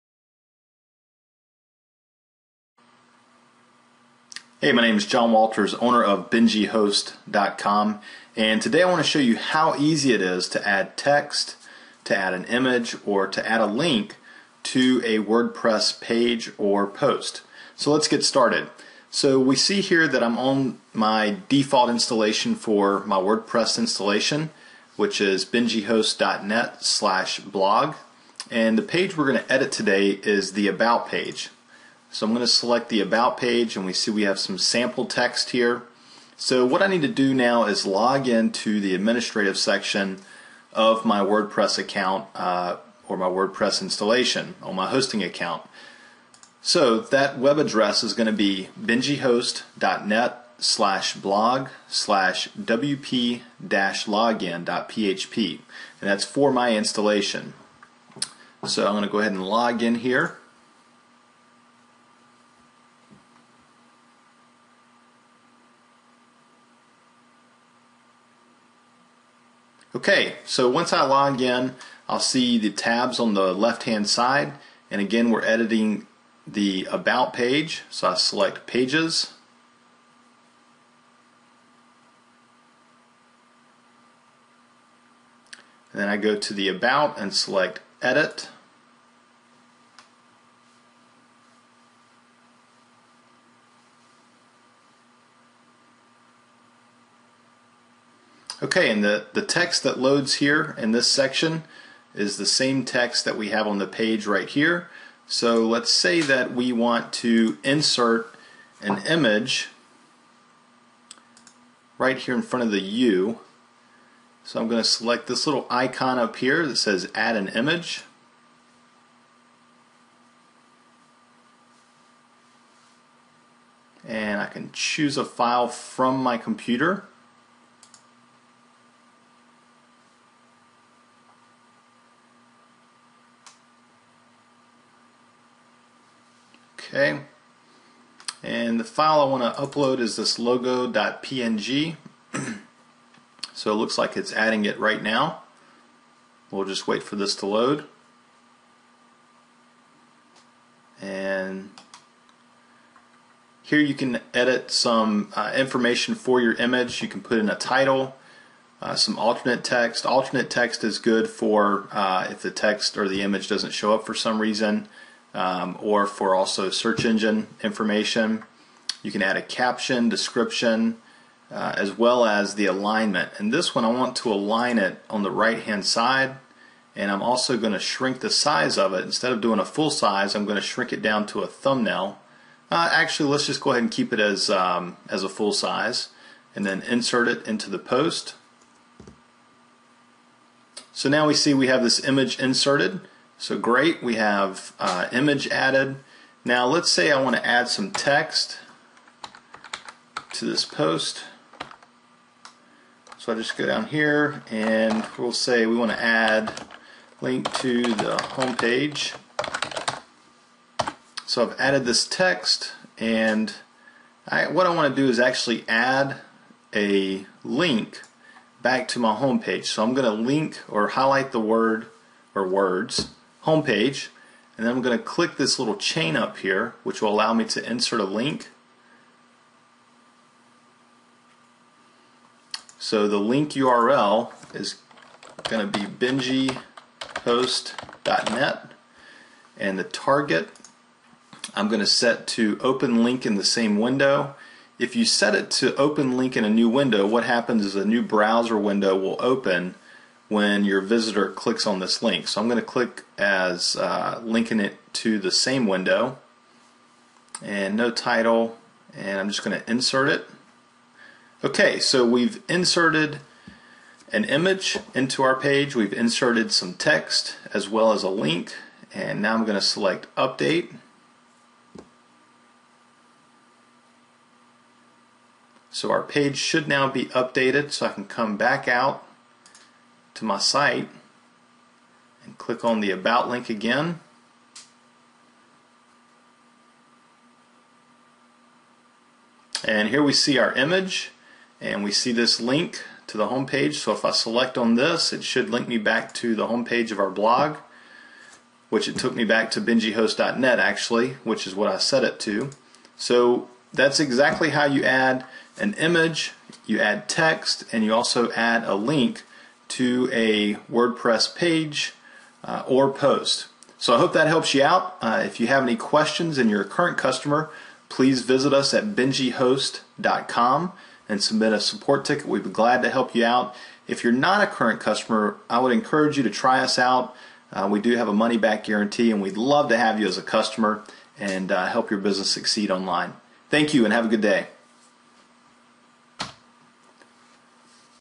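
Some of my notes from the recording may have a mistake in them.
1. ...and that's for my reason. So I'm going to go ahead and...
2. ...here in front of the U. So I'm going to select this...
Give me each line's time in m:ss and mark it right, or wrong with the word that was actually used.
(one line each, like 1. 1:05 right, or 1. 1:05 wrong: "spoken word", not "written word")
1. 0:56 wrong: "installation", not "reason"
2. 1:52 right.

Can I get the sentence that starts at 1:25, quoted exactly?
And then I go to the About and select Edit.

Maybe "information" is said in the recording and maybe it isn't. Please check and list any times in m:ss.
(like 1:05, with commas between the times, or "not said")
2:35, 2:47.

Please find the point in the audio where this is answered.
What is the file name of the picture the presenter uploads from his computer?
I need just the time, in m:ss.
2:20.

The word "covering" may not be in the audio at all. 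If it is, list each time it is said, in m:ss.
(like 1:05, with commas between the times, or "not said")
not said.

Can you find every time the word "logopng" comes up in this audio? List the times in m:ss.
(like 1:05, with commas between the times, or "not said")
2:20.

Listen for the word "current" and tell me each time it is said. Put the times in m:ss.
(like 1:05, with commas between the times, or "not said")
5:16, 5:24.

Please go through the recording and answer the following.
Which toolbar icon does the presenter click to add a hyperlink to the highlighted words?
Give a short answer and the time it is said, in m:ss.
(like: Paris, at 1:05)
little chain, at 3:45.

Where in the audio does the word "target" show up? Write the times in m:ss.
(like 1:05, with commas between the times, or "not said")
3:59.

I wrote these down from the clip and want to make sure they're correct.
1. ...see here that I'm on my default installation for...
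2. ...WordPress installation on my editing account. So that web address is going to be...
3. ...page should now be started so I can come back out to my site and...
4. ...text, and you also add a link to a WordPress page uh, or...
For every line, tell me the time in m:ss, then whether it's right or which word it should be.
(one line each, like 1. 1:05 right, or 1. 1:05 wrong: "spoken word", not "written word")
1. 0:19 right
2. 0:43 wrong: "hosting", not "editing"
3. 4:36 wrong: "updated", not "started"
4. 5:07 right.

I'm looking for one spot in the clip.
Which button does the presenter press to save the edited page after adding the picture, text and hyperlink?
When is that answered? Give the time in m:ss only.
4:30.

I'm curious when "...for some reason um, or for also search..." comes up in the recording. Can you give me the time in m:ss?
2:44.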